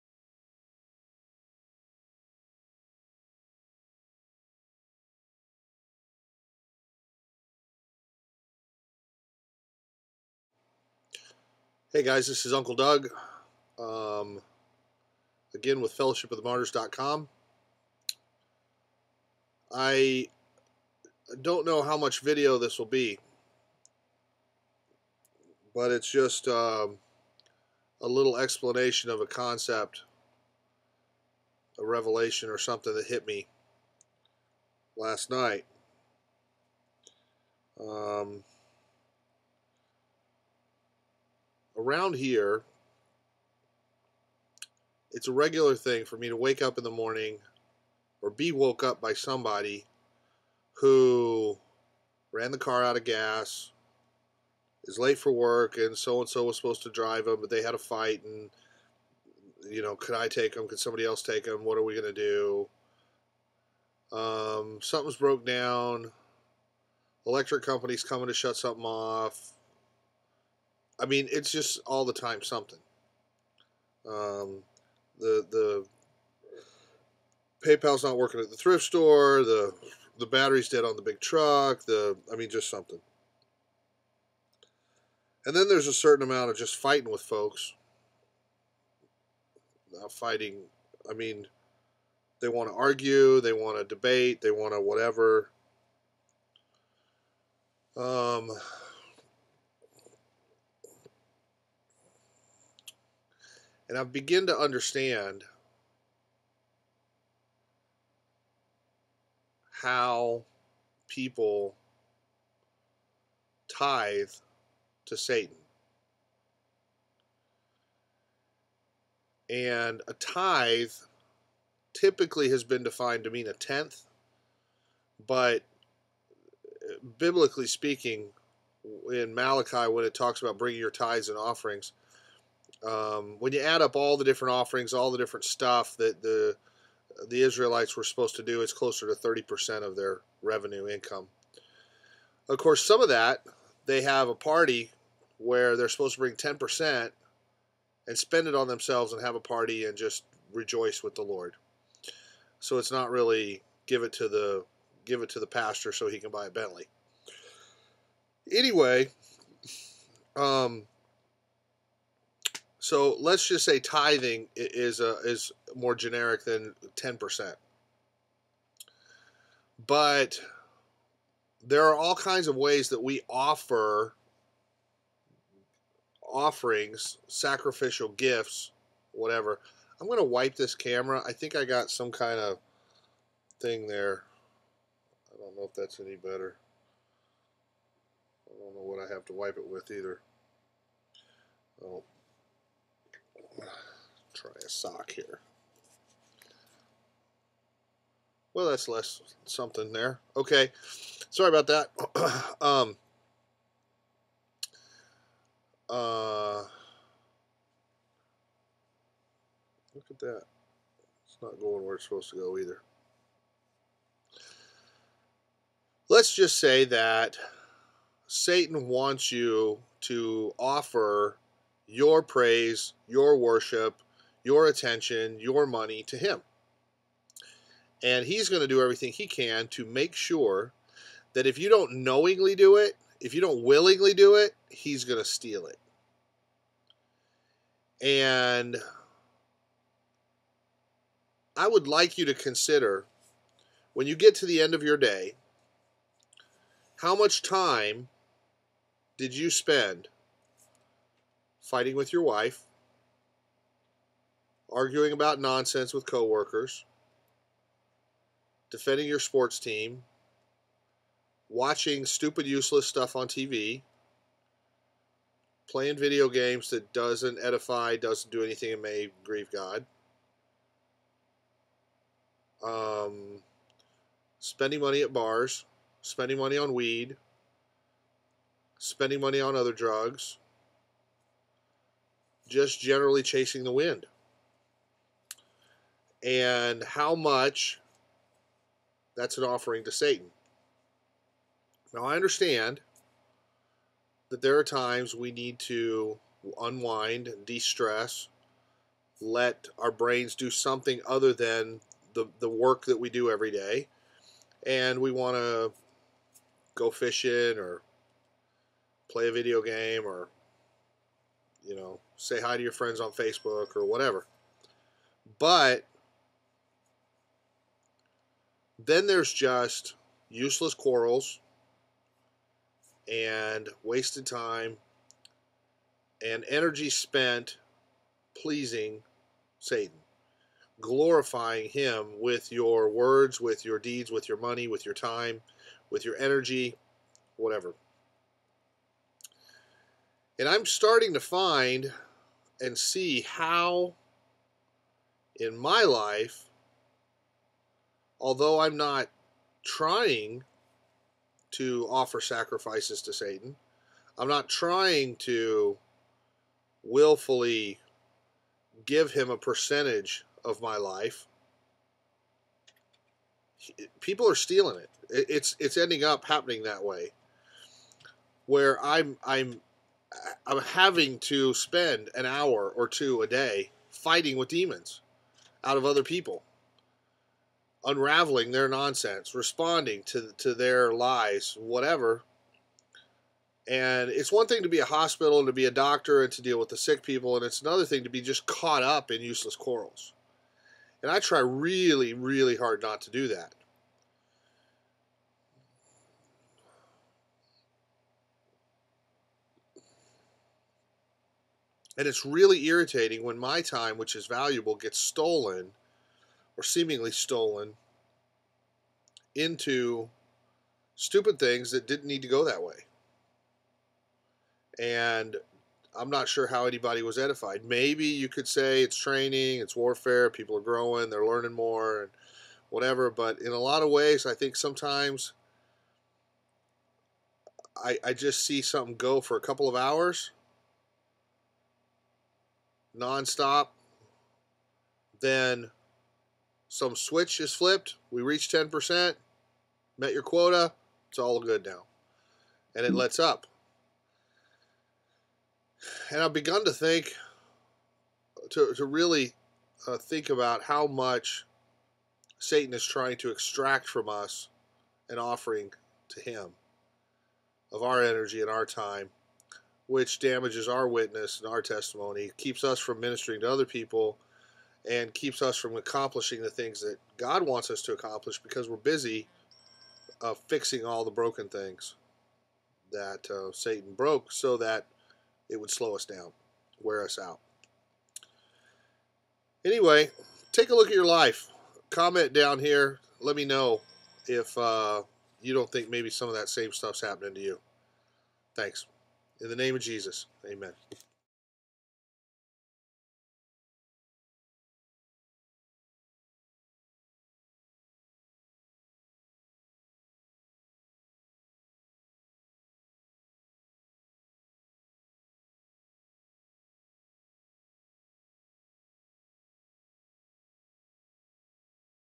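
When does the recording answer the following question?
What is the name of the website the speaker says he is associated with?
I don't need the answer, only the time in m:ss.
0:15.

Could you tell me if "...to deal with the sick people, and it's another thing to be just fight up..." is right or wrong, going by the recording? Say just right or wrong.
wrong.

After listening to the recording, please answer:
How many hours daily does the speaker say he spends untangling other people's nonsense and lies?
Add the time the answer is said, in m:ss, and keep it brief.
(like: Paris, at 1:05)
1 or 2, at 6:12.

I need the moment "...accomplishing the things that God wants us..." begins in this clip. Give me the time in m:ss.
7:45.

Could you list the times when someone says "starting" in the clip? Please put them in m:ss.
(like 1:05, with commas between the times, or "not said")
5:40.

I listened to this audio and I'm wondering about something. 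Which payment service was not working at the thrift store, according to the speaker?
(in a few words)
PayPal.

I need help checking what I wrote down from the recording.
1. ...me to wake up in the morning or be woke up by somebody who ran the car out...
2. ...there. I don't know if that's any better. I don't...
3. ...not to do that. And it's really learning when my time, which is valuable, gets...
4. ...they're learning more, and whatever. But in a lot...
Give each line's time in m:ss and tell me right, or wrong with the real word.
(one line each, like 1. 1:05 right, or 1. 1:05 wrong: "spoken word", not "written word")
1. 0:46 right
2. 3:03 right
3. 6:32 wrong: "irritating", not "learning"
4. 7:01 right.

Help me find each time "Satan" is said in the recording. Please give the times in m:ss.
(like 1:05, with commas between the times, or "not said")
1:55, 3:38, 4:49, 5:29, 5:53, 7:32, 7:53.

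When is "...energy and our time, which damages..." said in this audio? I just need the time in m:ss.
7:38.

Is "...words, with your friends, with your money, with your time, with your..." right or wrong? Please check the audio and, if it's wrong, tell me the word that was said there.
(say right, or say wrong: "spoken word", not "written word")
wrong: "deeds", not "friends".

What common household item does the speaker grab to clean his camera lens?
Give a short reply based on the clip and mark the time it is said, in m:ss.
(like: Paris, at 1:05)
A sock, at 3:14.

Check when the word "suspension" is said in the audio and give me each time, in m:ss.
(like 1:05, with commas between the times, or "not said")
not said.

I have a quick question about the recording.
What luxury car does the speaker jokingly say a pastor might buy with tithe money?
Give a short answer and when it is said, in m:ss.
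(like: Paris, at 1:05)
Bentley, at 2:36.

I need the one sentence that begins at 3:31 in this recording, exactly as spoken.
It's not going where it's supposed to go either.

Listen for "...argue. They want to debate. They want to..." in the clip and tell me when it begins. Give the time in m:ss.
1:32.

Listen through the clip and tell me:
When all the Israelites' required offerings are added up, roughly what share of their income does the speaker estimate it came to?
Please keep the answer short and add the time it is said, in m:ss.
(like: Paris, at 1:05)
30%, at 2:19.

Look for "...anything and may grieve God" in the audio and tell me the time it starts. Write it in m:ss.
4:28.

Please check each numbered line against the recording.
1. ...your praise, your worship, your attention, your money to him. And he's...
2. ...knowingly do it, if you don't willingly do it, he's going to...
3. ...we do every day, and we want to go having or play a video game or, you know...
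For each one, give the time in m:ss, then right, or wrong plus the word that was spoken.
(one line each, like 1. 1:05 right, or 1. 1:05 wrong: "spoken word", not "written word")
1. 3:41 right
2. 3:52 right
3. 5:02 wrong: "fishing", not "having".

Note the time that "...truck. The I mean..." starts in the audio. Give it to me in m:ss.
1:21.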